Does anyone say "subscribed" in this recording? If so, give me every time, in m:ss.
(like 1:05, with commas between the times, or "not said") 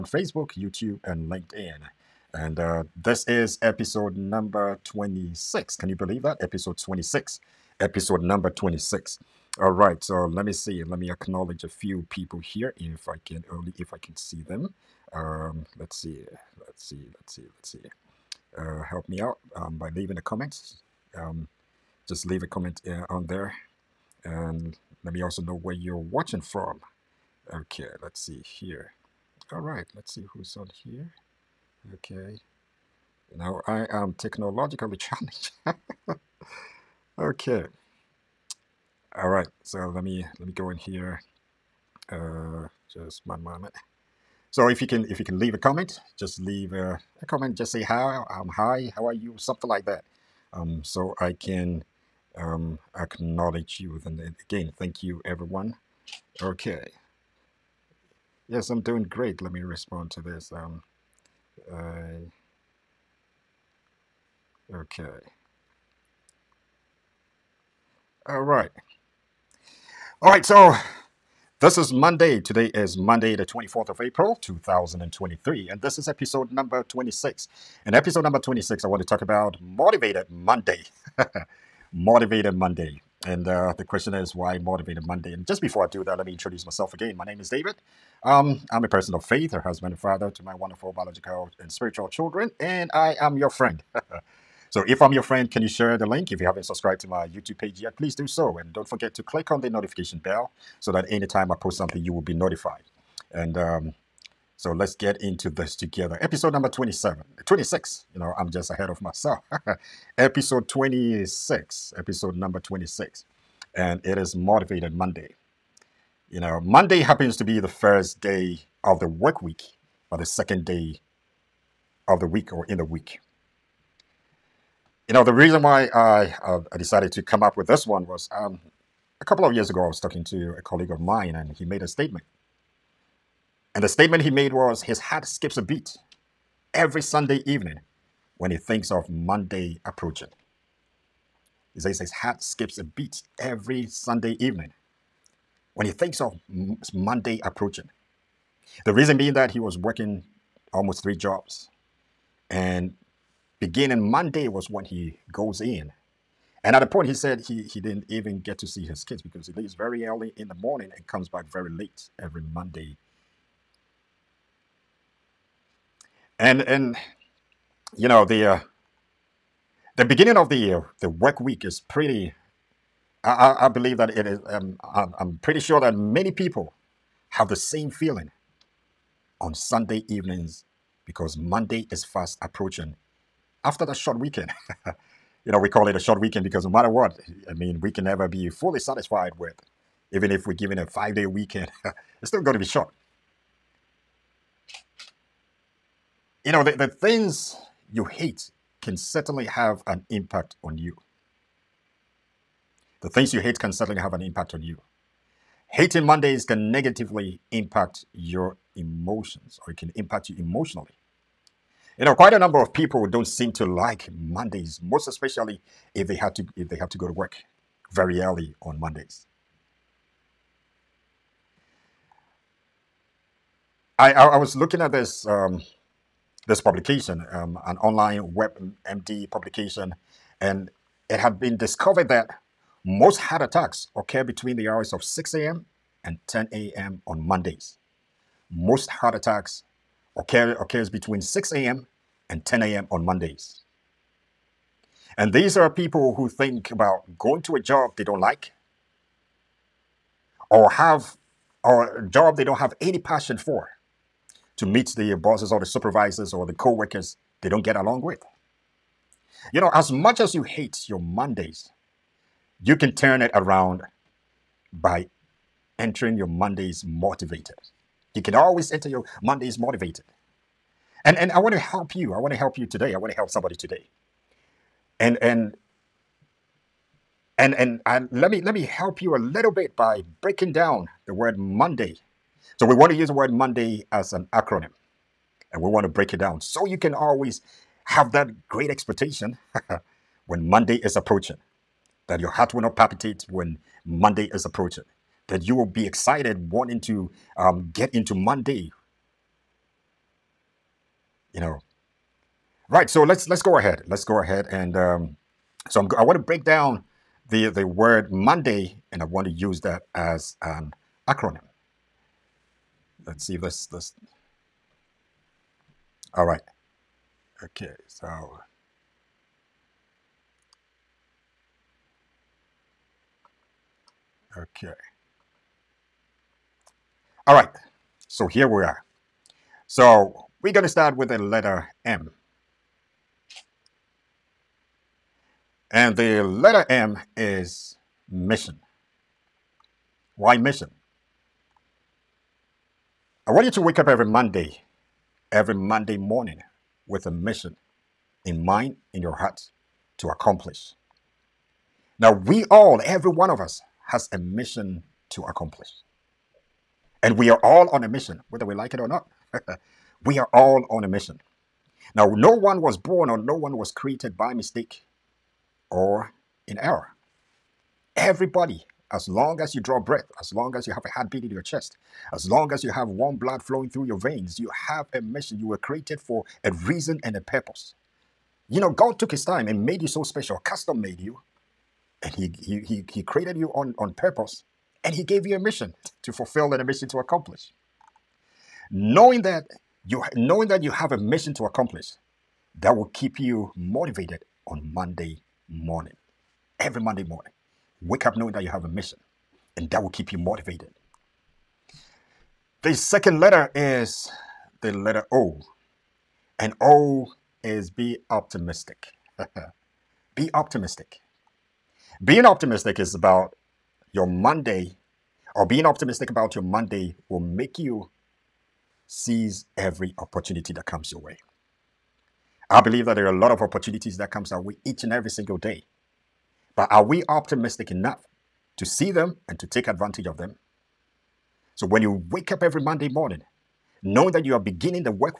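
1:36.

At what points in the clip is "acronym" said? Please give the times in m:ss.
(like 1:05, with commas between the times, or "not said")
4:44, 5:11.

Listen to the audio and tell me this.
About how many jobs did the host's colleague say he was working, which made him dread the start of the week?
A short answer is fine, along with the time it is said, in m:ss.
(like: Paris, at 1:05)
3, at 2:31.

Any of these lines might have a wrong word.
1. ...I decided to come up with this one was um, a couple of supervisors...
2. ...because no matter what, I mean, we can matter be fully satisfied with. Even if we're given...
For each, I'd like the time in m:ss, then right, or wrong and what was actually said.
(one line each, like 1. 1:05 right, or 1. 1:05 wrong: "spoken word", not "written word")
1. 2:06 wrong: "years", not "supervisors"
2. 3:06 wrong: "never", not "matter".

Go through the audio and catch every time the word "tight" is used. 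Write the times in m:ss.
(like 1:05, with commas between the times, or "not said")
not said.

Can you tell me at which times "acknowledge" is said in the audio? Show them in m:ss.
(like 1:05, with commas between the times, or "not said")
0:11, 0:52.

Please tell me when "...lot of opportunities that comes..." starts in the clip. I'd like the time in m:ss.
7:03.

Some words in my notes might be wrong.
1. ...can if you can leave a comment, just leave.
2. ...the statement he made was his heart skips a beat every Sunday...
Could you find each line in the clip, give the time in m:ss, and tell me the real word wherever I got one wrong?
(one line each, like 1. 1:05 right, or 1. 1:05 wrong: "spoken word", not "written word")
1. 0:44 right
2. 2:13 right.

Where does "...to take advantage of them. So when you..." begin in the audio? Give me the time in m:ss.
7:09.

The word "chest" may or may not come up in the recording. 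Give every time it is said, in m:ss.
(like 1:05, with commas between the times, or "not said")
6:11.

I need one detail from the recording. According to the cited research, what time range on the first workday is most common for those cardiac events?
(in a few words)
6 a.m. to 10 a.m.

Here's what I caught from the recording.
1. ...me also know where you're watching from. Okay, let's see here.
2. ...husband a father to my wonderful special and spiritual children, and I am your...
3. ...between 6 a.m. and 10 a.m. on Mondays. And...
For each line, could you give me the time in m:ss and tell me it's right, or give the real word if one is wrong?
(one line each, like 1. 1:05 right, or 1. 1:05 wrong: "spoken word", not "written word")
1. 0:25 right
2. 1:29 wrong: "biological", not "special"
3. 4:00 right.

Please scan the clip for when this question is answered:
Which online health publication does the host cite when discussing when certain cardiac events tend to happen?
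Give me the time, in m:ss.
3:48.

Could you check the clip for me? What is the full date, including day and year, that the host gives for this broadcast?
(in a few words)
24th of April, 2023.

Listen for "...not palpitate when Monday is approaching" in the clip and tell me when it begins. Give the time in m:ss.
4:52.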